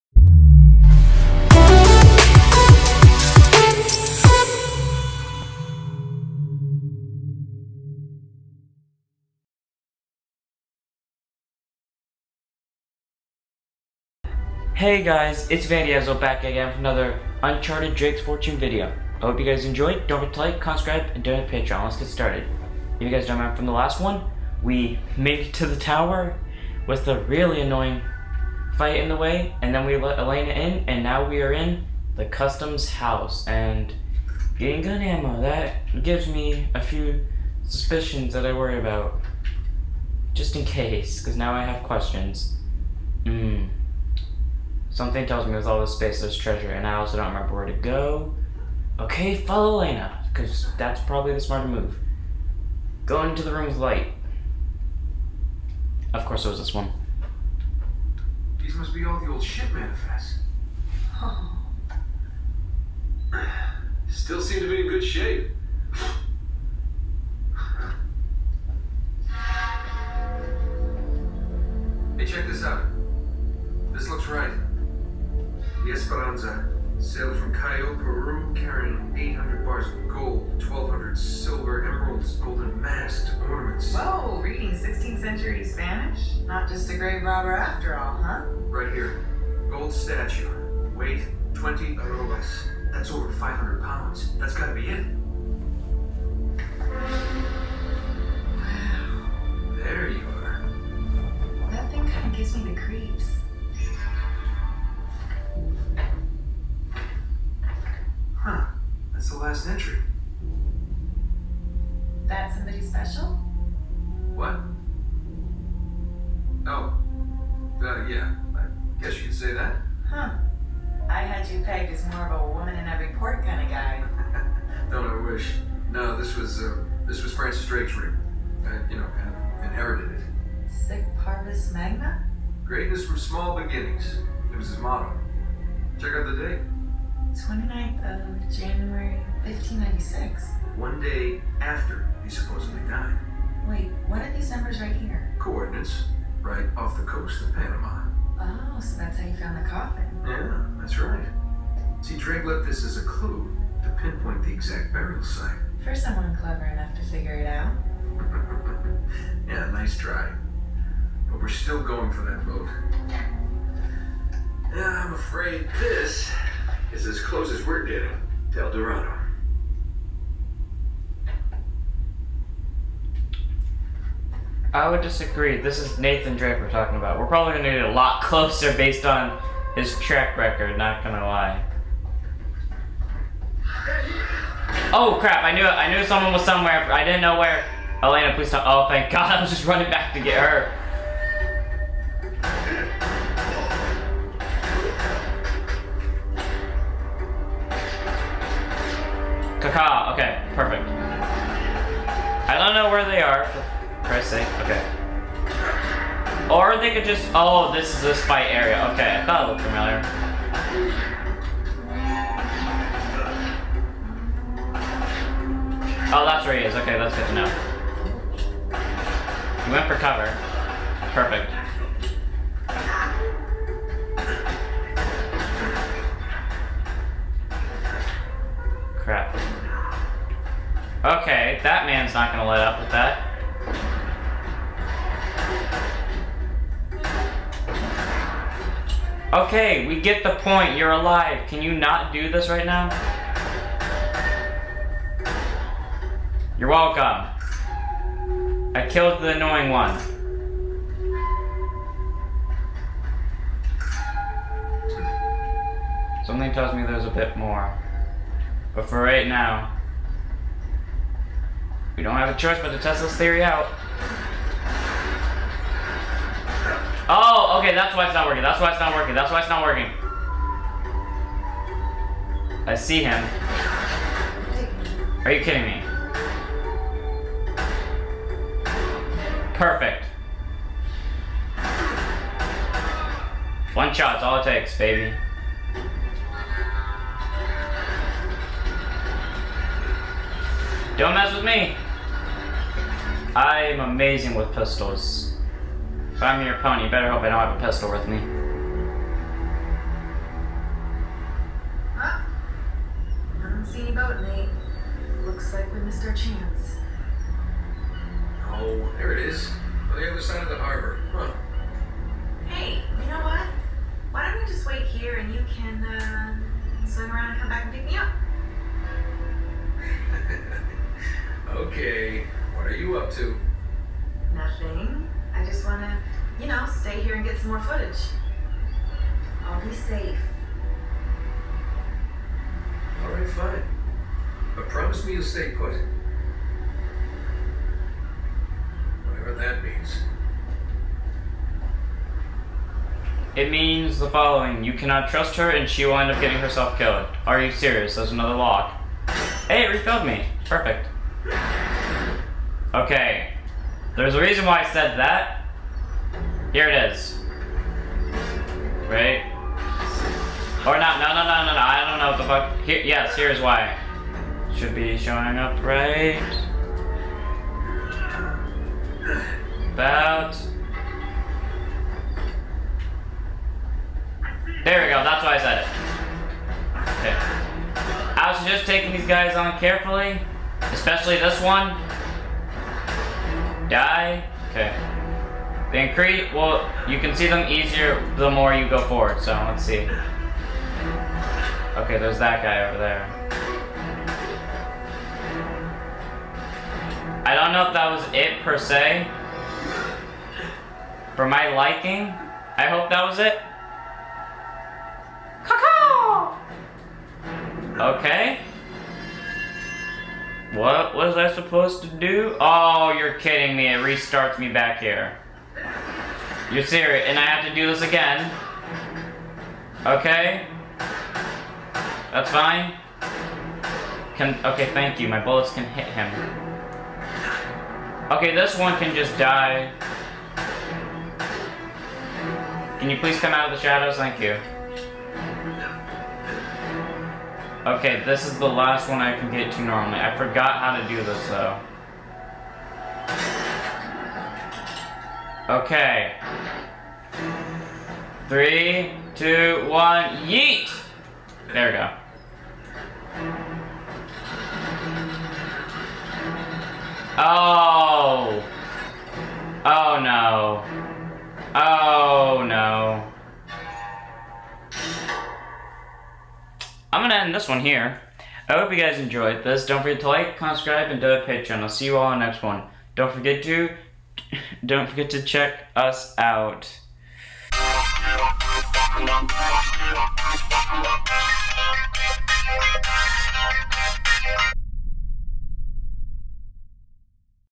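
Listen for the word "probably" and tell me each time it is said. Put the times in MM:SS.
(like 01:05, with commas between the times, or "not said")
00:51, 02:57.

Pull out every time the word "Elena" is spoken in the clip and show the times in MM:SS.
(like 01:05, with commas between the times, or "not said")
00:30, 00:49, 03:08.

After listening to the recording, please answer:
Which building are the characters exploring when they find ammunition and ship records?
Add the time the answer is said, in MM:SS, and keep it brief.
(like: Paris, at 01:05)
the customs house, at 00:32.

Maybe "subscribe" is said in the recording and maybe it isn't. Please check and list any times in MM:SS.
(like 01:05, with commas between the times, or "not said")
00:20, 07:50.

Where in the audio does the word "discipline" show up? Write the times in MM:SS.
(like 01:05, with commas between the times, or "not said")
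not said.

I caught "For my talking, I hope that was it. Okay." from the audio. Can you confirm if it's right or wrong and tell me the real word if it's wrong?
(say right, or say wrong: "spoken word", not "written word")
wrong: "liking", not "talking".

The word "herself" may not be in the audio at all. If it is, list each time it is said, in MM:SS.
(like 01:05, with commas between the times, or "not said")
05:46.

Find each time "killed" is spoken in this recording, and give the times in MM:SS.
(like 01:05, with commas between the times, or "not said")
04:08, 05:46.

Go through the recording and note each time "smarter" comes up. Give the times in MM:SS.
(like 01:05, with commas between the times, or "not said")
00:51.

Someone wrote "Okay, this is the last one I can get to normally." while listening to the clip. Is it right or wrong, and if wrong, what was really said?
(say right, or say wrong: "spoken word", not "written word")
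right.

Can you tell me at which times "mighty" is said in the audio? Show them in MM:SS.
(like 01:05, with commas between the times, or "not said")
not said.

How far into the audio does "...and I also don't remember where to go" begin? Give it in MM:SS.
00:46.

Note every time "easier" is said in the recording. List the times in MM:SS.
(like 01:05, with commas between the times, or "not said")
06:27.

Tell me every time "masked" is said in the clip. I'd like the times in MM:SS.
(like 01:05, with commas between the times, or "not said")
01:22.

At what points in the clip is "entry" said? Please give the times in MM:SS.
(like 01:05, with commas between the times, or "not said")
01:49.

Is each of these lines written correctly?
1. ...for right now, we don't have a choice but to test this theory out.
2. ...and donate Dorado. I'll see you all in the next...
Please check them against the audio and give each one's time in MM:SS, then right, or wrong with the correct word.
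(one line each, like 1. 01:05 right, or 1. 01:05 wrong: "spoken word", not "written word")
1. 04:18 right
2. 07:50 wrong: "Patreon", not "Dorado".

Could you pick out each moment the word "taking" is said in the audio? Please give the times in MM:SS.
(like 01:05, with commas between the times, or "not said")
06:18.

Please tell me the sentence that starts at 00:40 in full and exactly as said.
Just in case, because now I have questions.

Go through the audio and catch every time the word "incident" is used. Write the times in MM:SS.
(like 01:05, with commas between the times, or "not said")
not said.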